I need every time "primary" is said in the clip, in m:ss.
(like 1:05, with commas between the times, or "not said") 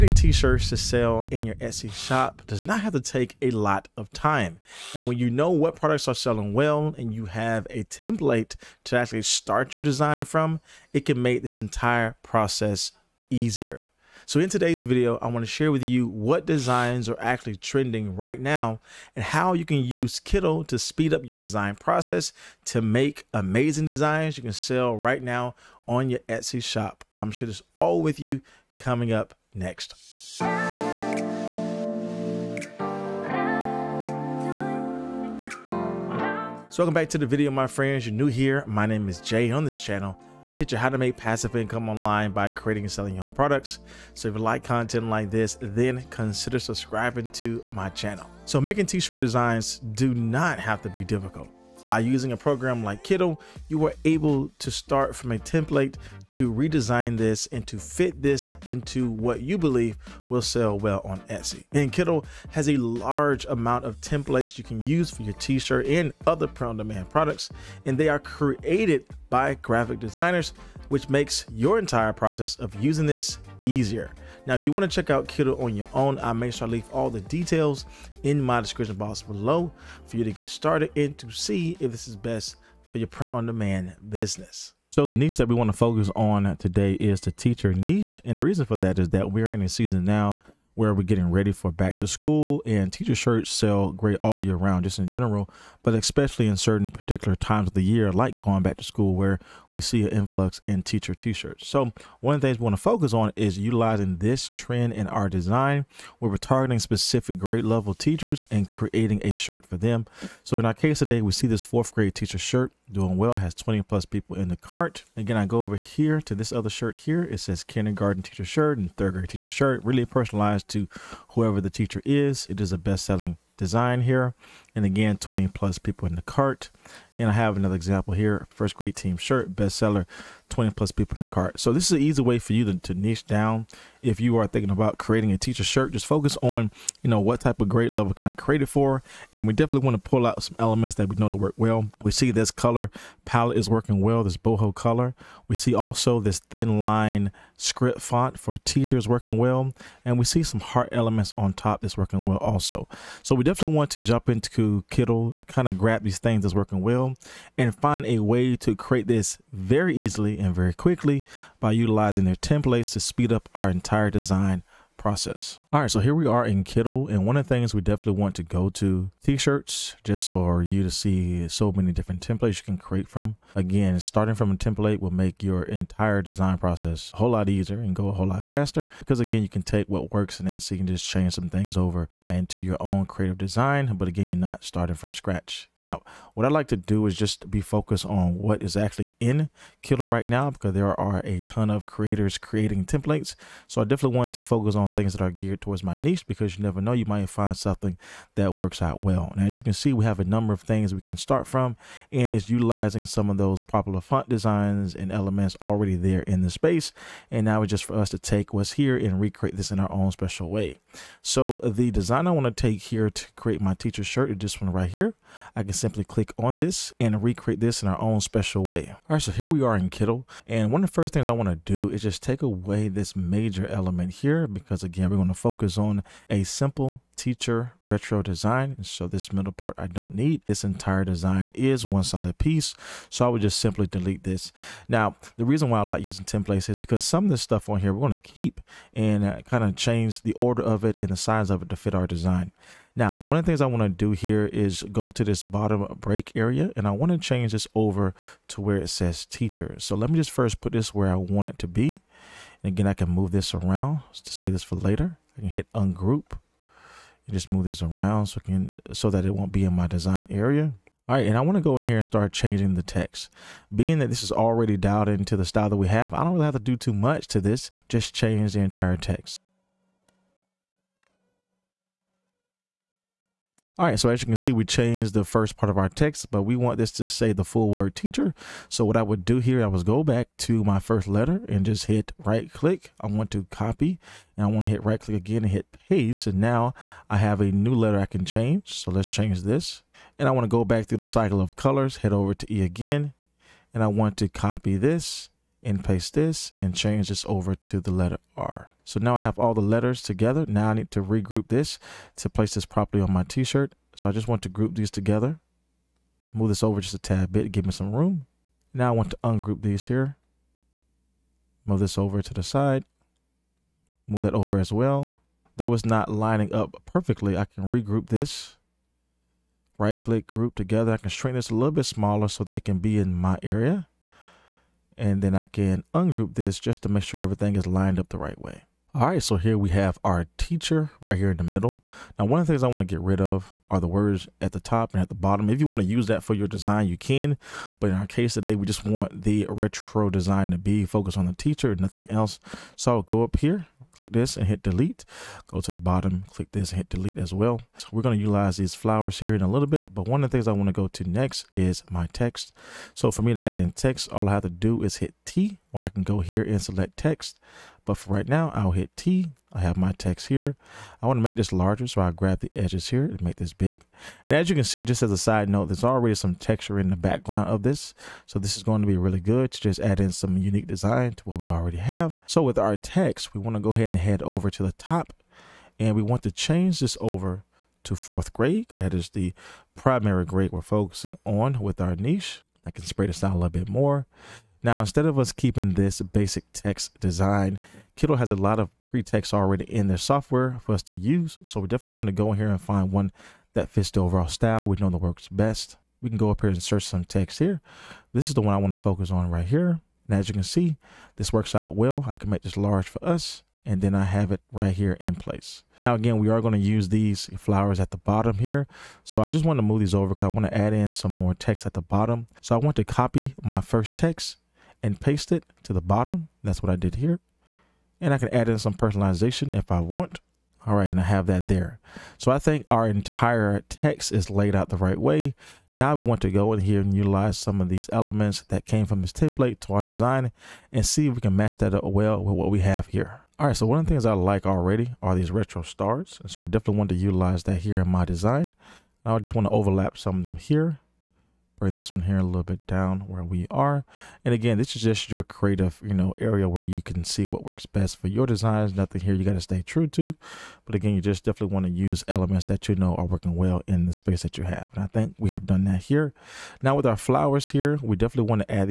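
6:19.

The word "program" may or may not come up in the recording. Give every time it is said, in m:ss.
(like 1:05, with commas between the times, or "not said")
0:52.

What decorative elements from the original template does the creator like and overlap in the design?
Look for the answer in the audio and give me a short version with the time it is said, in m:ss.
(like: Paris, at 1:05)
Retro stars, at 7:15.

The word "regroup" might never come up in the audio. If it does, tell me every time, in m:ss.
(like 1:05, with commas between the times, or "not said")
5:01, 5:17.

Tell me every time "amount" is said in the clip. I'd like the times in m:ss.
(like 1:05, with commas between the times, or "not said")
1:03.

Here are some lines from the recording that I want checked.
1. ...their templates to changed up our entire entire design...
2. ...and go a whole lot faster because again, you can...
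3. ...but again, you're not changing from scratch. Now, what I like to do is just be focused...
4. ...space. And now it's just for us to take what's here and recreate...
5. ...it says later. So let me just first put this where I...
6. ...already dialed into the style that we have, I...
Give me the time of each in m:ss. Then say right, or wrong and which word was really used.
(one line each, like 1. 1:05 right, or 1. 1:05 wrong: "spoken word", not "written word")
1. 2:42 wrong: "speed", not "changed"
2. 2:57 right
3. 3:03 wrong: "starting", not "changing"
4. 3:26 right
5. 4:08 wrong: "teacher", not "later"
6. 4:24 right.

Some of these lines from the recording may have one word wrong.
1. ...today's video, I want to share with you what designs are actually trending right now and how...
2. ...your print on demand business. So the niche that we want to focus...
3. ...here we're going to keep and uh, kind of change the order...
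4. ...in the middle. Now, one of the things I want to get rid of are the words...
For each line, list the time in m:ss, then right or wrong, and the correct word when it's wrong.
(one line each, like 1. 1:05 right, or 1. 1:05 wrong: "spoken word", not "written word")
1. 0:14 right
2. 1:22 right
3. 3:57 right
4. 5:31 right.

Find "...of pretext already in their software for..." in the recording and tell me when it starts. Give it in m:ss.
6:28.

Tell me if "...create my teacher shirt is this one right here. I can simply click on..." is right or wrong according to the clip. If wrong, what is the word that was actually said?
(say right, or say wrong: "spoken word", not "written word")
right.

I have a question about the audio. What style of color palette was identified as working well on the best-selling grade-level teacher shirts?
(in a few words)
Boho.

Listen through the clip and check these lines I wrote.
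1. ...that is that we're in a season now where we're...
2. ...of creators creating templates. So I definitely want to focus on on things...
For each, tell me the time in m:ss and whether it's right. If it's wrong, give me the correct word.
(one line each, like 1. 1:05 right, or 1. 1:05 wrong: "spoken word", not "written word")
1. 1:28 right
2. 3:11 right.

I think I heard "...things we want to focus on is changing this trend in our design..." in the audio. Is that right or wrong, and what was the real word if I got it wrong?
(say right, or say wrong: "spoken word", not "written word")
wrong: "utilizing", not "changing".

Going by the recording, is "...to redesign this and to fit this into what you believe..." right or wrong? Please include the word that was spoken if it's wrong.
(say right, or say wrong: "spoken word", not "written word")
right.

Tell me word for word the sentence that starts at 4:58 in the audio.
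So now I have all the letters together.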